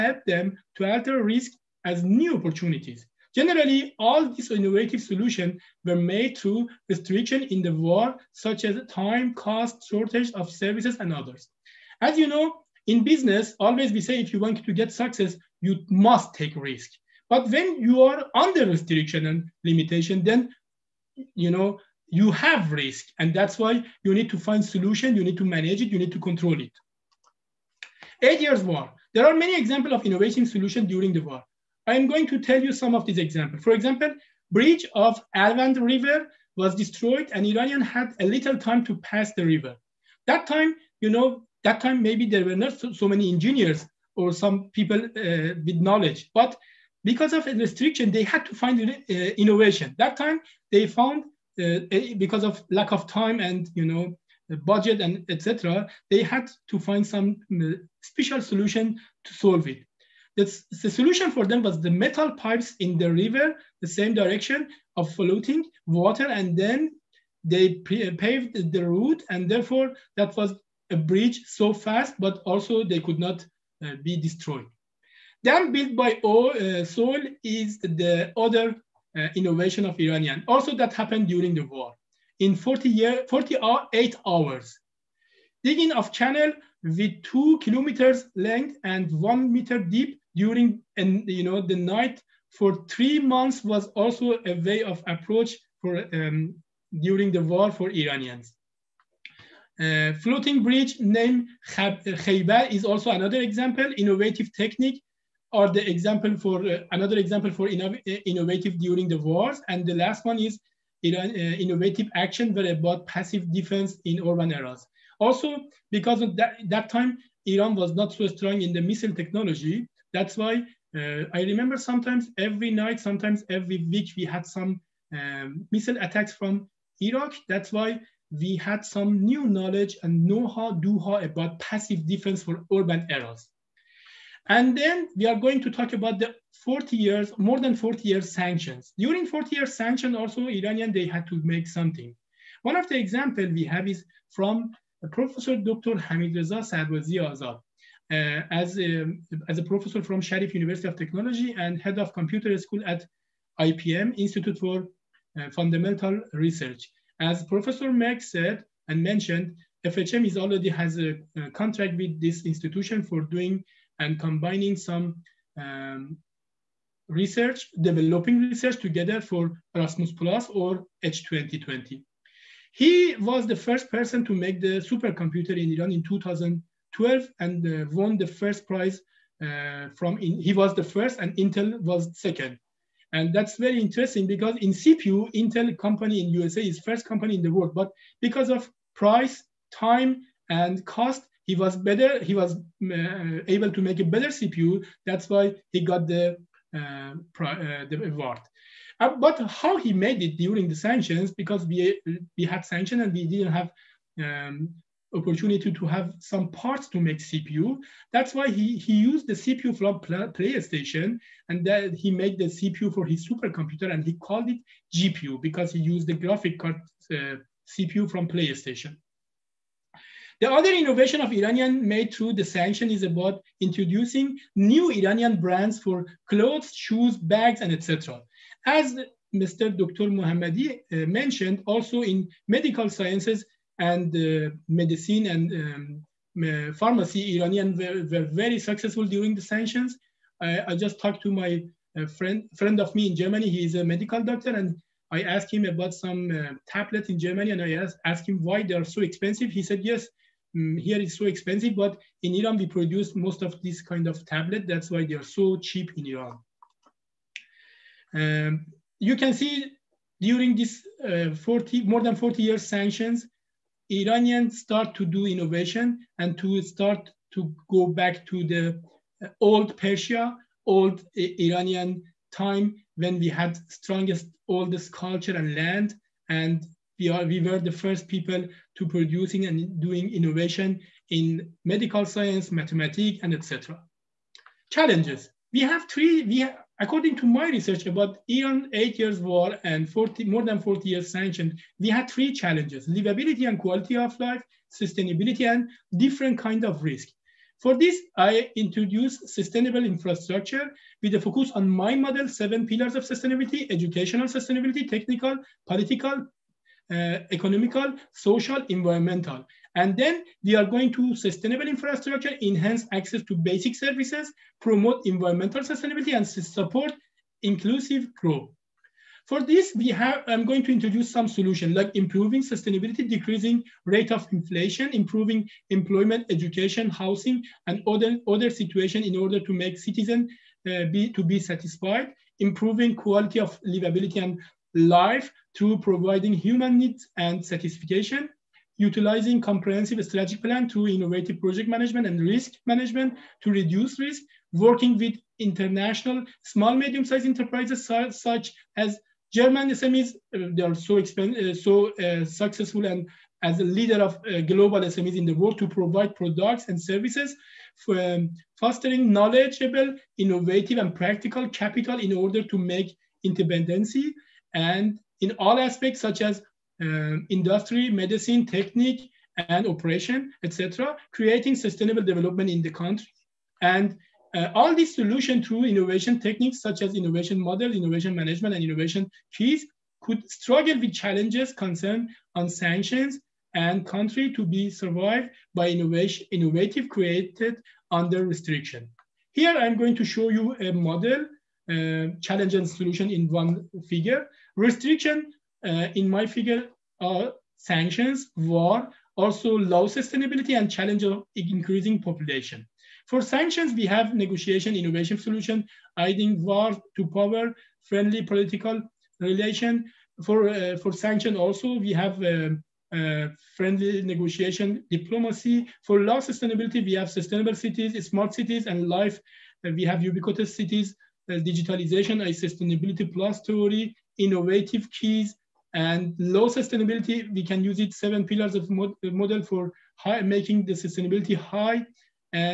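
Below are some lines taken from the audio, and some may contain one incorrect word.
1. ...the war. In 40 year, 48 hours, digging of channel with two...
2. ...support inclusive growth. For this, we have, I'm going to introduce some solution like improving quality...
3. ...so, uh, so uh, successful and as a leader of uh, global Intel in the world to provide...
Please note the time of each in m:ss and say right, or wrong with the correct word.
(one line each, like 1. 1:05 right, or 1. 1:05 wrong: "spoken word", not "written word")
1. 1:21 right
2. 5:16 wrong: "sustainability", not "quality"
3. 5:50 wrong: "SMEs", not "Intel".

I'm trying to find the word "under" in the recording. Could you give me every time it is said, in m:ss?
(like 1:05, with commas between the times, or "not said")
0:18, 6:27.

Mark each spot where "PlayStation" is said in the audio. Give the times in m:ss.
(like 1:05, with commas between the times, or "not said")
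3:29, 3:38.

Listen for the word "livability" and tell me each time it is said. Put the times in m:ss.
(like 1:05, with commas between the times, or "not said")
4:52, 5:33.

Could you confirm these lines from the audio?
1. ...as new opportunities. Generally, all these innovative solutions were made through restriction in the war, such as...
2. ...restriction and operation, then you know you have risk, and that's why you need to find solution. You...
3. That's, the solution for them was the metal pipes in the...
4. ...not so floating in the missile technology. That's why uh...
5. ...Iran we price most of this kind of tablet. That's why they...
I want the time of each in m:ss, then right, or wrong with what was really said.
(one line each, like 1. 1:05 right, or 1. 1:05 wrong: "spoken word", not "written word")
1. 0:01 right
2. 0:18 wrong: "limitation", not "operation"
3. 1:00 right
4. 1:57 wrong: "strong", not "floating"
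5. 4:12 wrong: "produce", not "price".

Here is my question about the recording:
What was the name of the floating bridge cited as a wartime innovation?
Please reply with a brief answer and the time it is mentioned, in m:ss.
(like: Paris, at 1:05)
Khaibar, at 1:41.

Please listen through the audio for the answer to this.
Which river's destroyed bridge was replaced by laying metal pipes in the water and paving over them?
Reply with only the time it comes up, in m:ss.
0:35.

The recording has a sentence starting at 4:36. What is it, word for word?
And we, are, we were the first people to producing and doing innovation in medical science, mathematics, and etc.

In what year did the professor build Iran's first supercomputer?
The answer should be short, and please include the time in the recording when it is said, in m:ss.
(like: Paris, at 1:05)
2012, at 2:56.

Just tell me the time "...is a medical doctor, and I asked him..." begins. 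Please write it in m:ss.
4:03.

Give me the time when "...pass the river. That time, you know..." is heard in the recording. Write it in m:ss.
0:39.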